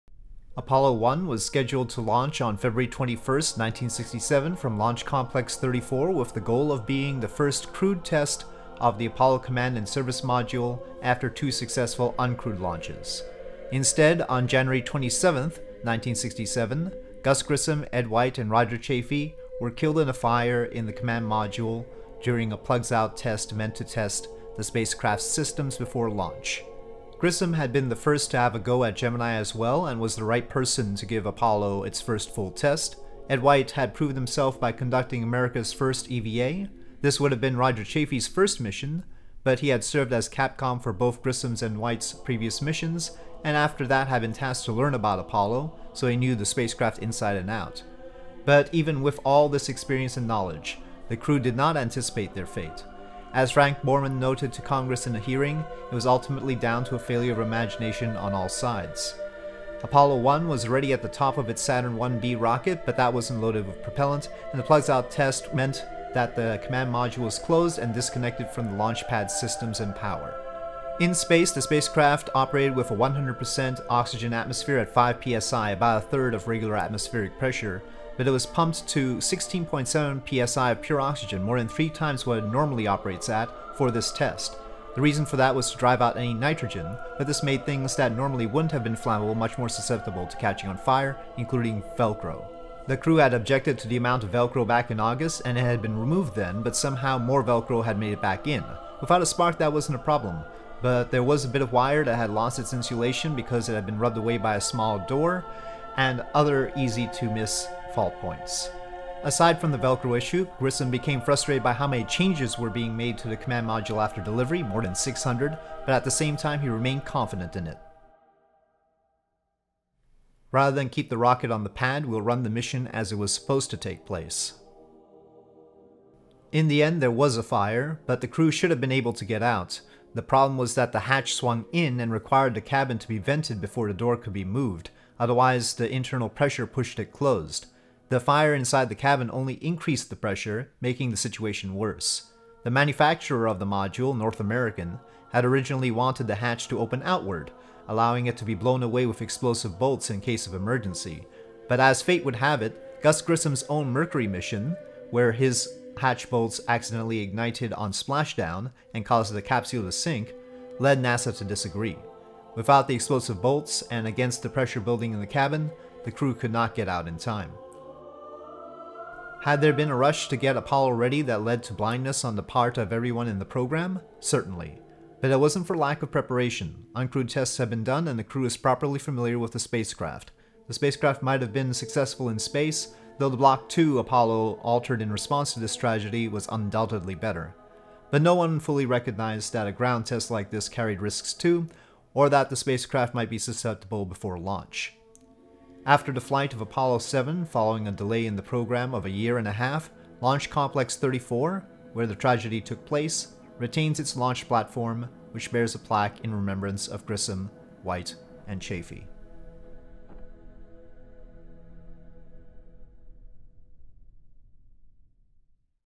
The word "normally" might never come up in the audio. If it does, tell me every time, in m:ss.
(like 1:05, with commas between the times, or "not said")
1:22, 1:28.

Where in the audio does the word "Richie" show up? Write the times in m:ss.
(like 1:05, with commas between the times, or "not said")
not said.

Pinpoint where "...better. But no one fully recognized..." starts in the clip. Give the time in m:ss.
3:07.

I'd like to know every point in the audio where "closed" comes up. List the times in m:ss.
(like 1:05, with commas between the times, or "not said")
1:07, 2:17.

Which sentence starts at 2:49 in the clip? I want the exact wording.
Had there been a rush to get Apollo ready that led to blindness on the part of everyone in the program?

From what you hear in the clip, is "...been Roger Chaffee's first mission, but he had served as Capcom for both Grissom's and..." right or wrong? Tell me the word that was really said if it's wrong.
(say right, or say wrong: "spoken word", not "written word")
right.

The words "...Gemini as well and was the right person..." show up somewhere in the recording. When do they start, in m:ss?
0:28.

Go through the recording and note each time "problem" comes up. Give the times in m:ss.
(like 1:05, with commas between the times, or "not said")
1:40, 2:10.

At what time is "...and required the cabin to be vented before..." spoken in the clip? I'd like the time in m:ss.
2:12.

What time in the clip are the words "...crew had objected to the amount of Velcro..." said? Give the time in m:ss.
1:32.